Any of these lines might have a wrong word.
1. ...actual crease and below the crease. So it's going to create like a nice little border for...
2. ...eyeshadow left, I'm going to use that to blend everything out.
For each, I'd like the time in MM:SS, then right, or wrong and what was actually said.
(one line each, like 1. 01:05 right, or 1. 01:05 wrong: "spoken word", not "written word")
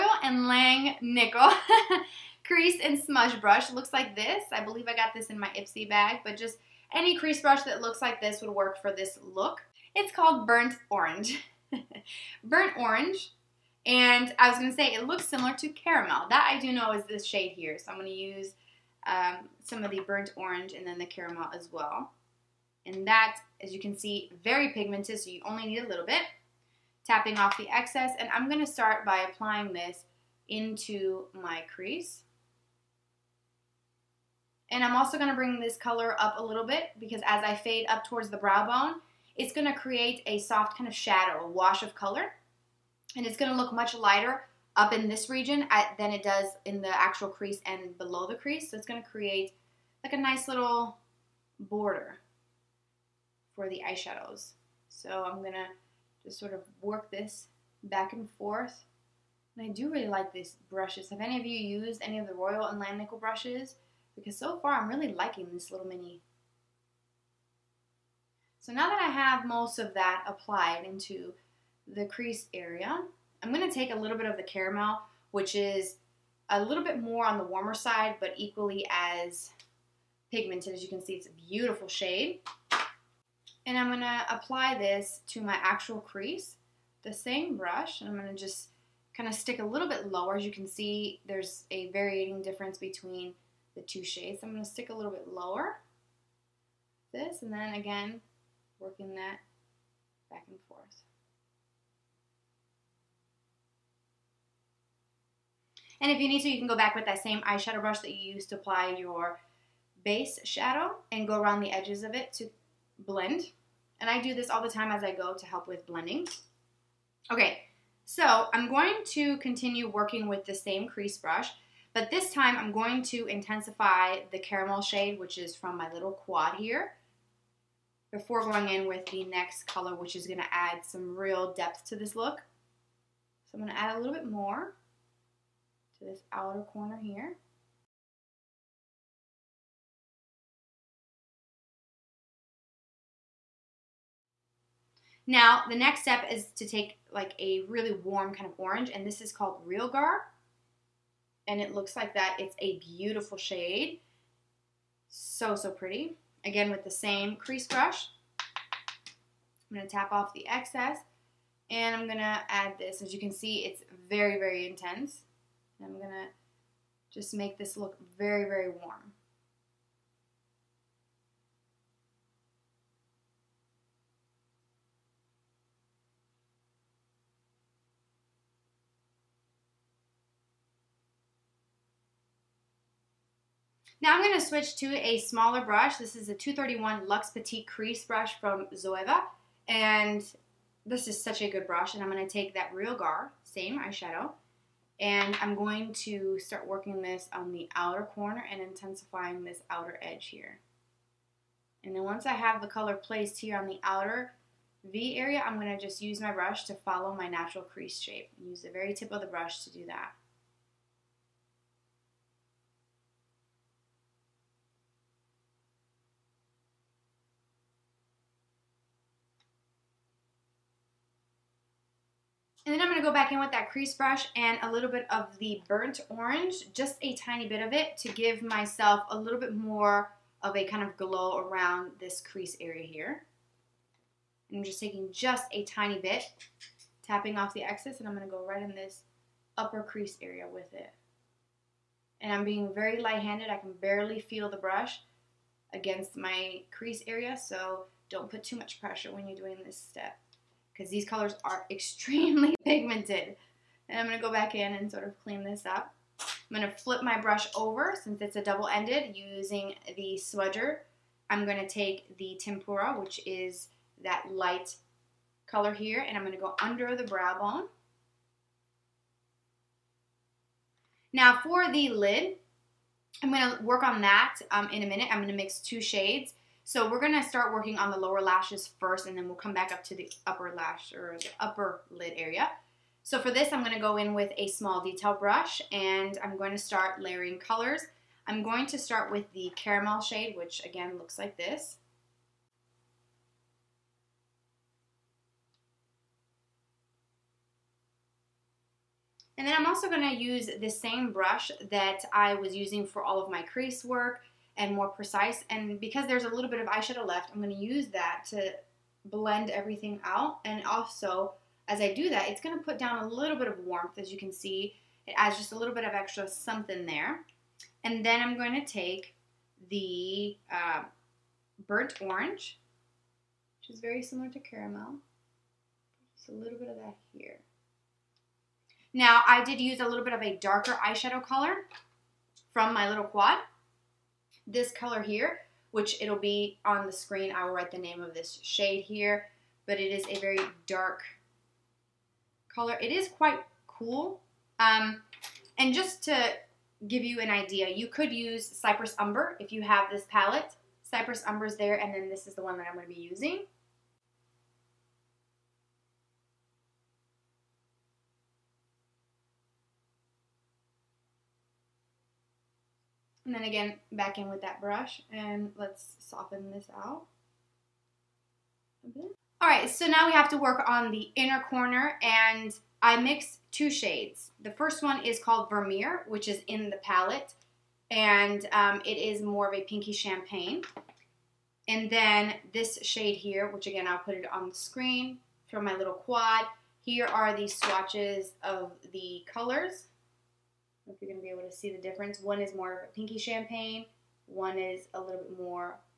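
1. 00:47 right
2. 05:06 right.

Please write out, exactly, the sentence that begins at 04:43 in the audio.
So for this, I'm gonna go in with a small detail brush and I'm going to start layering colors.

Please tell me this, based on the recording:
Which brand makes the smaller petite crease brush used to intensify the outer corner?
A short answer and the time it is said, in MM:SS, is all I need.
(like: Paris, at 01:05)
Zoeva, at 03:08.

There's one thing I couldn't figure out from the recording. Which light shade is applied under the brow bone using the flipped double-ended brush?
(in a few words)
Tempera.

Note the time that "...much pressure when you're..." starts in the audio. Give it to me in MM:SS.
04:08.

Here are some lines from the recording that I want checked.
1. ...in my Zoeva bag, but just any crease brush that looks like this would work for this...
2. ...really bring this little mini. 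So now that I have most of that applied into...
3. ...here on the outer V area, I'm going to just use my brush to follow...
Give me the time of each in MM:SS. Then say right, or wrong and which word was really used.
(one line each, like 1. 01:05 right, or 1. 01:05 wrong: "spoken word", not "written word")
1. 00:05 wrong: "Ipsy", not "Zoeva"
2. 01:04 wrong: "liking", not "bring"
3. 03:23 right.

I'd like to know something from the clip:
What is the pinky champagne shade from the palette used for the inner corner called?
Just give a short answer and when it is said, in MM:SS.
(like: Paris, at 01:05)
Vermeer, at 06:15.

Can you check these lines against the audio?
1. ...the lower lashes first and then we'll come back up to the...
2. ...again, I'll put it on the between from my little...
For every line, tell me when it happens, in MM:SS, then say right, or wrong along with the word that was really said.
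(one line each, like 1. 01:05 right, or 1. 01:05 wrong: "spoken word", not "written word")
1. 04:37 right
2. 06:23 wrong: "screen", not "between".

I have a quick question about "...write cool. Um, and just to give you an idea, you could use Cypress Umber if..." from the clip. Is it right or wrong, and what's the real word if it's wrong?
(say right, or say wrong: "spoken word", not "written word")
wrong: "quite", not "write".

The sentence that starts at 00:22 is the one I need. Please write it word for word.
And that, as you can see, very pigmented, so you only need a little bit.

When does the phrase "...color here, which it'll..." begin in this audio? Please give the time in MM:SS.
05:34.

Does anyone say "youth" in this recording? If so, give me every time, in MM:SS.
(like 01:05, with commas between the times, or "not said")
not said.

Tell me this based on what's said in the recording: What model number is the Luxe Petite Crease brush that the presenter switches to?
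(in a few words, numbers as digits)
231.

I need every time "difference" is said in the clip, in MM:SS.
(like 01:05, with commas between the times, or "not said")
01:32, 06:31.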